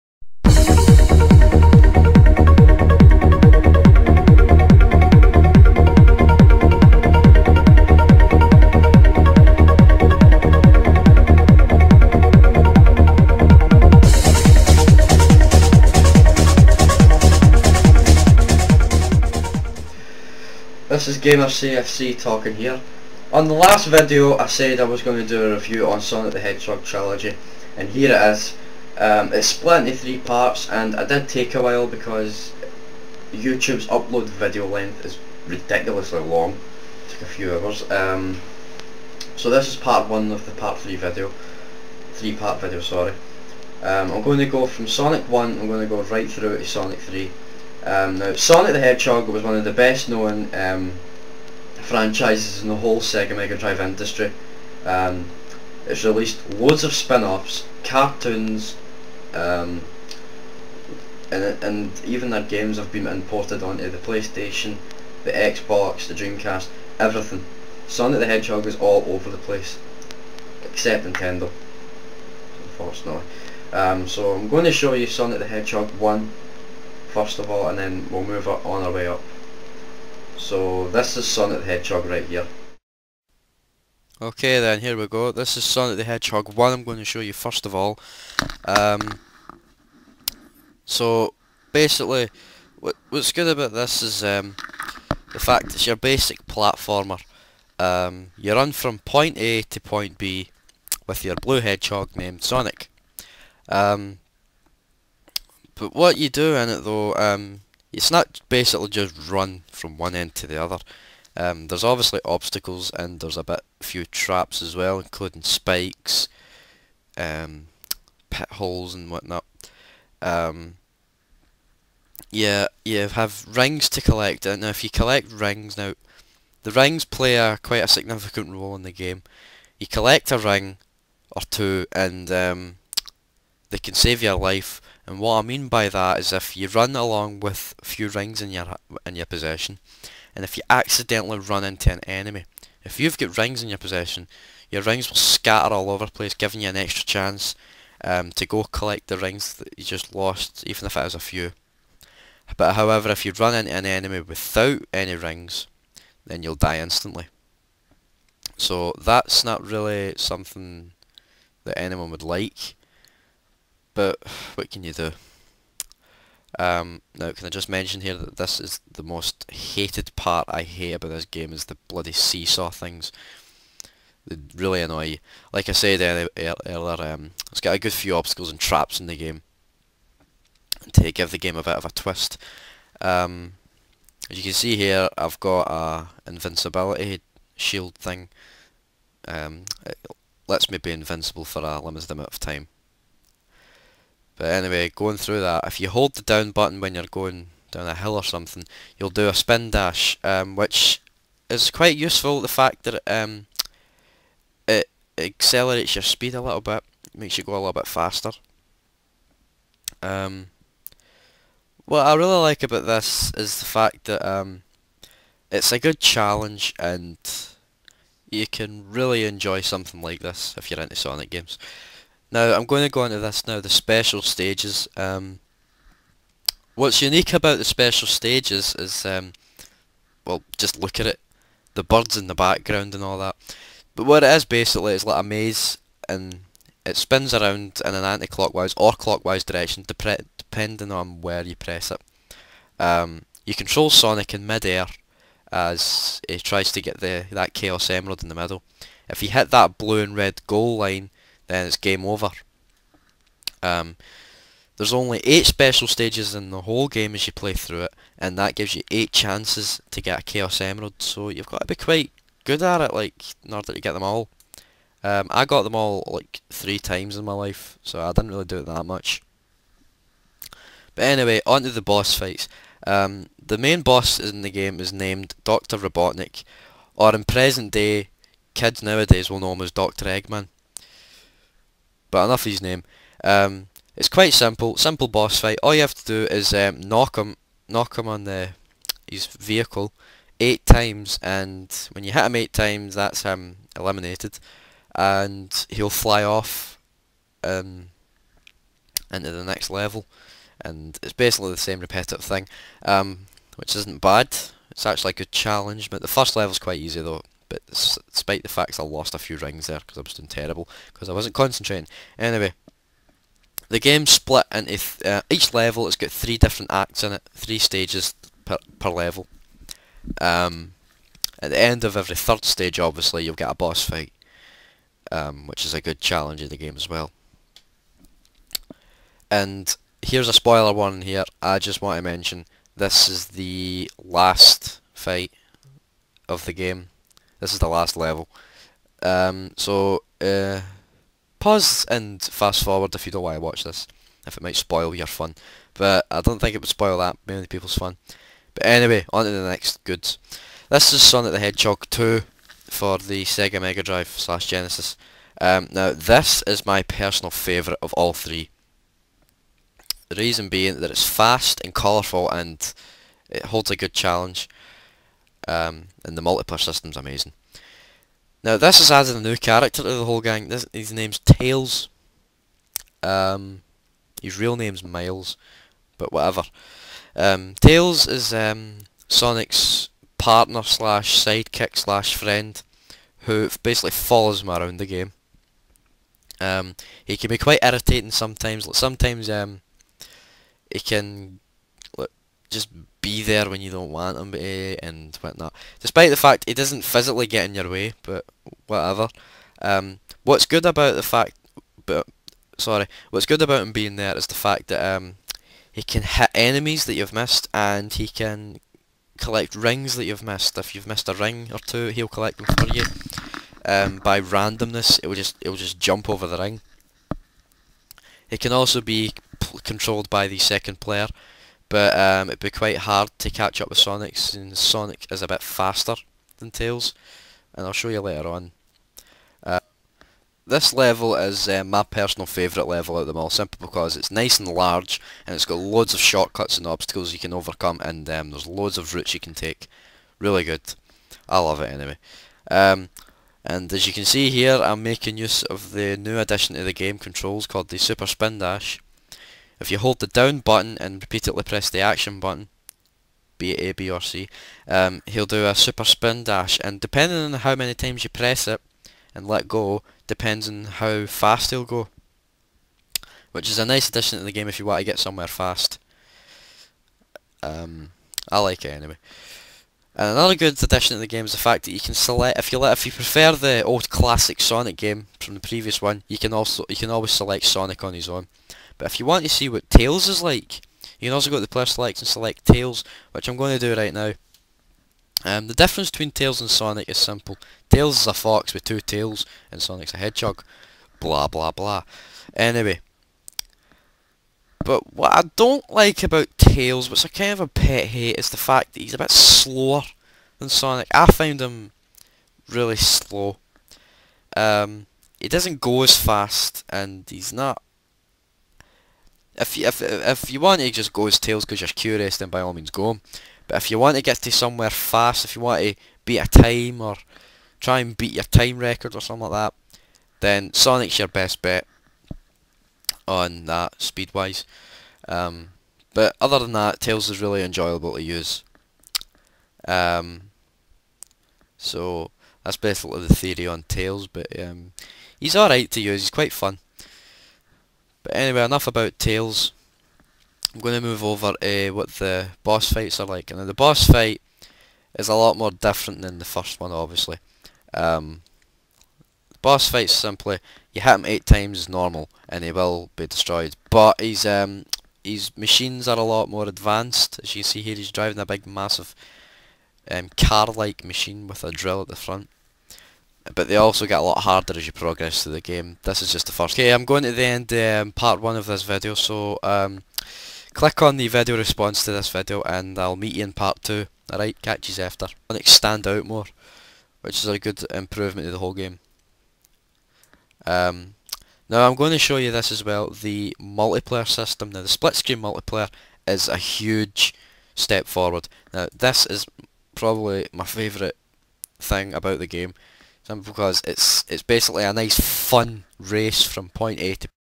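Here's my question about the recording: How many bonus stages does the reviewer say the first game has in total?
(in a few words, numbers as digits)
8.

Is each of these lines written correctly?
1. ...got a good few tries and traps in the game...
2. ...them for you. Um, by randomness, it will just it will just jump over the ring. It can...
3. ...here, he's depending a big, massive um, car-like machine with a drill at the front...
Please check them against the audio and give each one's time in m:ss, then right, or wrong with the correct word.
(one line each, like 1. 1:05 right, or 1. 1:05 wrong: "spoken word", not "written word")
1. 2:57 wrong: "obstacles", not "tries"
2. 6:52 right
3. 9:17 wrong: "driving", not "depending".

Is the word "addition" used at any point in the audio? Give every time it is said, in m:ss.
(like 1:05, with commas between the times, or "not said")
7:26, 7:43, 7:50.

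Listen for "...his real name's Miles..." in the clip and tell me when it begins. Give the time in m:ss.
6:14.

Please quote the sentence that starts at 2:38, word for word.
So that's not really something that anyone would like but what can you do?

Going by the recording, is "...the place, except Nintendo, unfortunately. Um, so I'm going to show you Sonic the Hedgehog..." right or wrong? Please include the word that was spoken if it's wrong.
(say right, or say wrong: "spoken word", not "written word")
right.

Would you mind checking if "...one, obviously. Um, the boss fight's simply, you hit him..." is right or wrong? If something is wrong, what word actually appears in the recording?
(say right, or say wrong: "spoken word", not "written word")
right.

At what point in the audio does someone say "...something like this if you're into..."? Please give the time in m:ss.
3:39.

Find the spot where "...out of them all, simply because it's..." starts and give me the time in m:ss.
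7:12.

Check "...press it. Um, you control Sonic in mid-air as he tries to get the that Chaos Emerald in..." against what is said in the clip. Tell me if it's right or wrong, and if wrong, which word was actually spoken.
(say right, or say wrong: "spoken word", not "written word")
right.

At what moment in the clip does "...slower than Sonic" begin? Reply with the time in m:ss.
8:19.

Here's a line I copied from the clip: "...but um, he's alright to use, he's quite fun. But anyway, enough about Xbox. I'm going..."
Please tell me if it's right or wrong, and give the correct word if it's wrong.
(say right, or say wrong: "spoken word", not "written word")
wrong: "Tails", not "Xbox".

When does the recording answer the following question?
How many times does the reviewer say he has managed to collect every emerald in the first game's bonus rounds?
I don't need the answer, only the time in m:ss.
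4:26.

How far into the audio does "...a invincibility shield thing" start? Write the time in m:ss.
3:05.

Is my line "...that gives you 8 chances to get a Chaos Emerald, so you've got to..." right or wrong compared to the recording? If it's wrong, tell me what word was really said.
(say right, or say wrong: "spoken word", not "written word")
right.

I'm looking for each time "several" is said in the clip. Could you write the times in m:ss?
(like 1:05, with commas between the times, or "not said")
not said.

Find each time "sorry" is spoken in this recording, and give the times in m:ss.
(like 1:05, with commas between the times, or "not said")
0:42, 6:42.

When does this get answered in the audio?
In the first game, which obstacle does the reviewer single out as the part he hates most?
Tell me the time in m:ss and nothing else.
2:52.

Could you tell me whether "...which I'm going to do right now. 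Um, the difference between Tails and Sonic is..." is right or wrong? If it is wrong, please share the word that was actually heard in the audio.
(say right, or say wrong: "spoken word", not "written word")
right.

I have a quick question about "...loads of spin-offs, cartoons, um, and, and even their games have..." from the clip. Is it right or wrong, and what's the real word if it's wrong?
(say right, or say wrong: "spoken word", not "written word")
right.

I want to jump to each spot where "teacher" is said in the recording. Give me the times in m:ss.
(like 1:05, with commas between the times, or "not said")
not said.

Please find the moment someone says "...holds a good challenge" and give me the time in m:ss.
6:03.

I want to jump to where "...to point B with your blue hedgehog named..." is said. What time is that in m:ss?
1:39.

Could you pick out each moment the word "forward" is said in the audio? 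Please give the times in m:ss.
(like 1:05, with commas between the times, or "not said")
5:42, 9:47.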